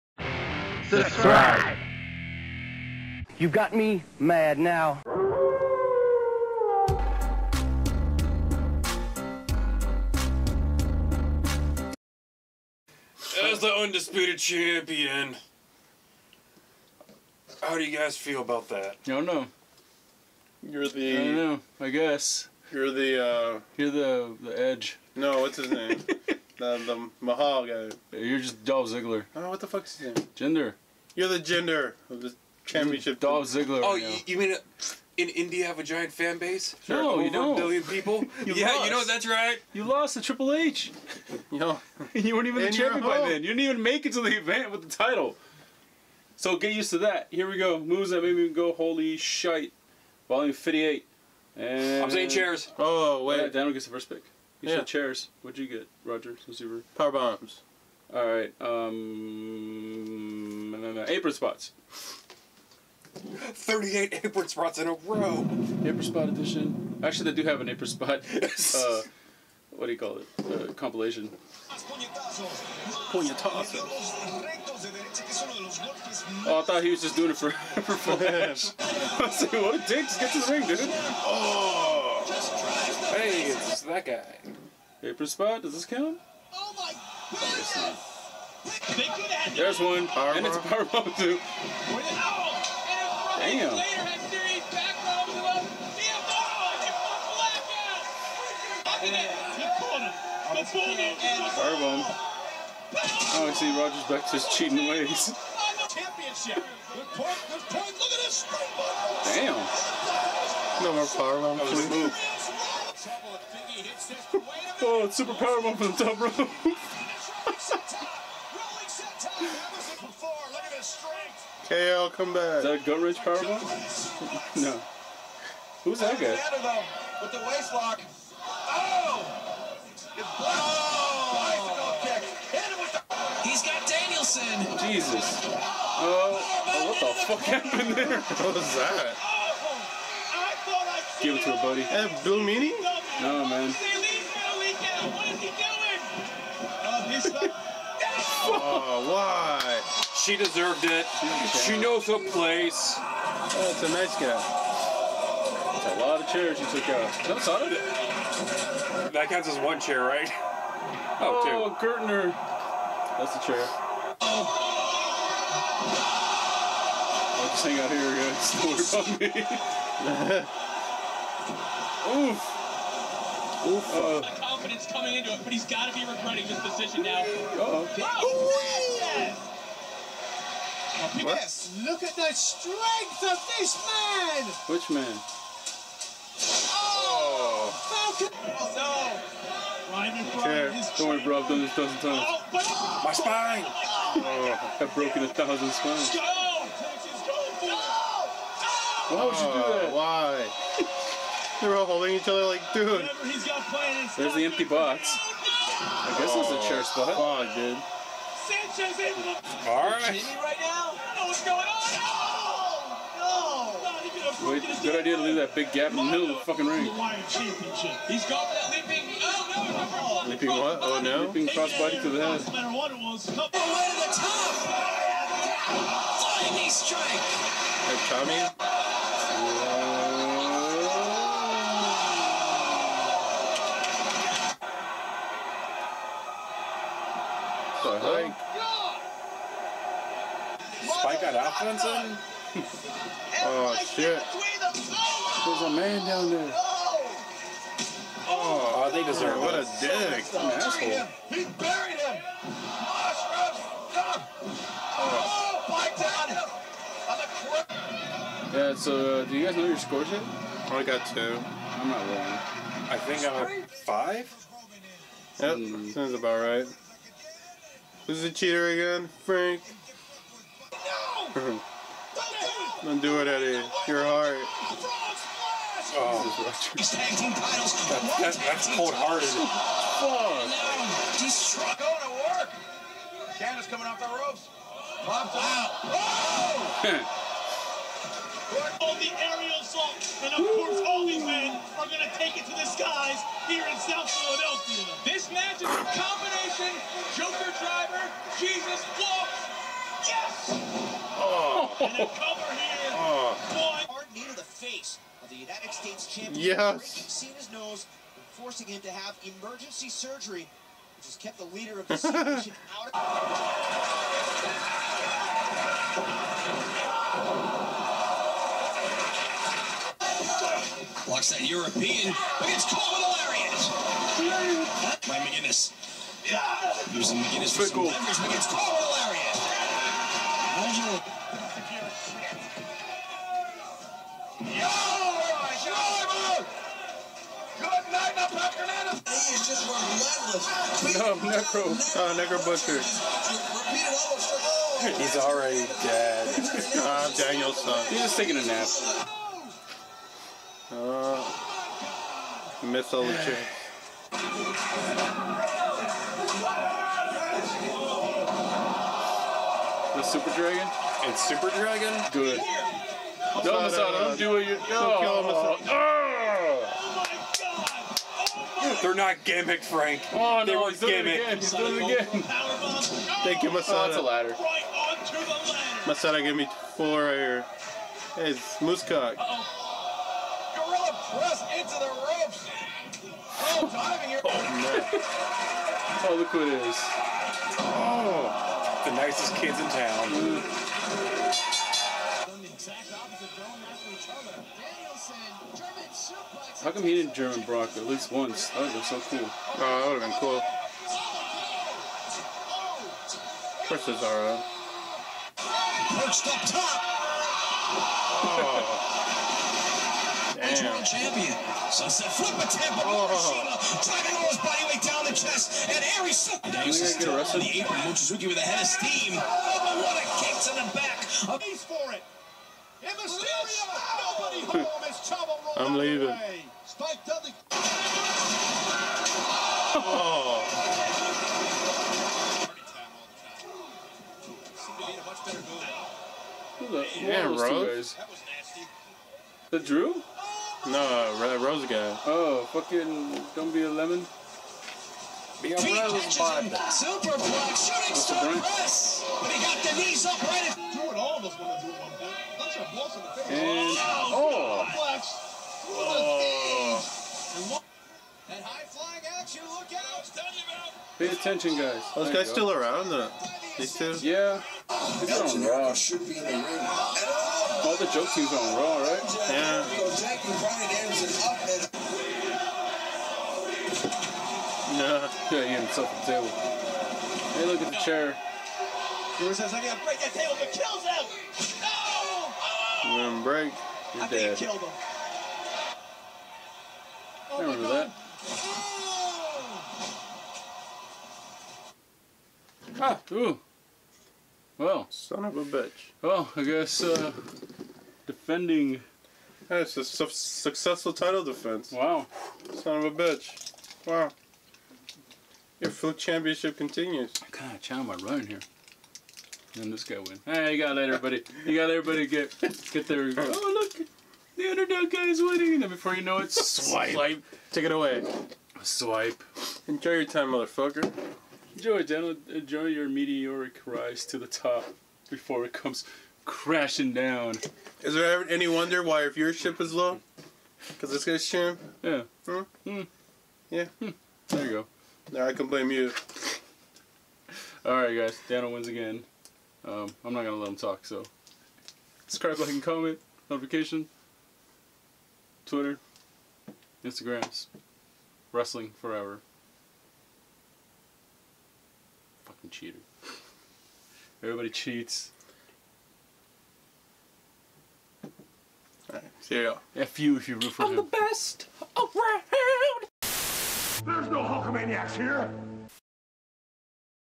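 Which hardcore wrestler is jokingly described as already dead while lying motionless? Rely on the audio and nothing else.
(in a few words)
Necro Butcher.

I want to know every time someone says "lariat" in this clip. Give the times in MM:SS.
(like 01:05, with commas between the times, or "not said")
05:22, 05:28.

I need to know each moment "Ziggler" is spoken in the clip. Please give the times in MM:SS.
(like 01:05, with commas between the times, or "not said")
00:28, 00:33.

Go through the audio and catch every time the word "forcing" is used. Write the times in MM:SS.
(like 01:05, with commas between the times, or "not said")
05:08.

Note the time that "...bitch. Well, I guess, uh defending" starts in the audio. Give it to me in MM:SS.
08:15.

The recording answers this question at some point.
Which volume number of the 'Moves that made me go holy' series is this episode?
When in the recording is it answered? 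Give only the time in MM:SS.
00:50.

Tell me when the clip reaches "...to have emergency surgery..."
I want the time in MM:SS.
05:08.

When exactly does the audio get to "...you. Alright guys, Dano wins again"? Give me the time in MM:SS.
08:55.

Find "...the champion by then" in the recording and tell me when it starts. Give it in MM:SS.
00:42.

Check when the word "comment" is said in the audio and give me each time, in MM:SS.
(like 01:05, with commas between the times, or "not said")
09:02.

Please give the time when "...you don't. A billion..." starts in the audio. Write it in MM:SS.
00:37.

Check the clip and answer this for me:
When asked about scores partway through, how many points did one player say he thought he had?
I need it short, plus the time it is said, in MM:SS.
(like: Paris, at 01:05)
5, at 04:23.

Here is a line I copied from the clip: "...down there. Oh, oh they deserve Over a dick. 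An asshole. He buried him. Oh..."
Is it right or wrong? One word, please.
wrong.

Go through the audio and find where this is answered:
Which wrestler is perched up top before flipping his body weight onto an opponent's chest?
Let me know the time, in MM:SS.
06:43.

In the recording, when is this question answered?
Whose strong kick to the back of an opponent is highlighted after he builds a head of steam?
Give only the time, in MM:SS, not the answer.
06:57.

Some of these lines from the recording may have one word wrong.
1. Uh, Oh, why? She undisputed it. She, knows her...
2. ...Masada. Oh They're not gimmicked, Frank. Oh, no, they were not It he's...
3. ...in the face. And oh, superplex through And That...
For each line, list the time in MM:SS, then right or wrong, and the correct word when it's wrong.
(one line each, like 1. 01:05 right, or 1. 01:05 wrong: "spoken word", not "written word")
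1. 02:27 wrong: "deserved", not "undisputed"
2. 06:08 right
3. 07:32 right.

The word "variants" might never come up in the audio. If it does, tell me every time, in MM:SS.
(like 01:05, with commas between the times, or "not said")
not said.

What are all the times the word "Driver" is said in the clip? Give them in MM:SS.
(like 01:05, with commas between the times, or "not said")
04:57.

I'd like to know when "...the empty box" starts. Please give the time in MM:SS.
03:24.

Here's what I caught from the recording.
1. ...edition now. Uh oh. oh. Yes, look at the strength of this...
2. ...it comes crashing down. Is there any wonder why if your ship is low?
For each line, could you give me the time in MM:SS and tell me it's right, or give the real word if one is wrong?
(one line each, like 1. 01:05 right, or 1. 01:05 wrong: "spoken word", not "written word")
1. 02:56 wrong: "position", not "edition"
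2. 08:45 right.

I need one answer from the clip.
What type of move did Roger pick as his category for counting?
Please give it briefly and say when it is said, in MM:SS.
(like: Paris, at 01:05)
Power bombs, at 00:56.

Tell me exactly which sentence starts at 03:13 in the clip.
oh, I've broken a thousand spines.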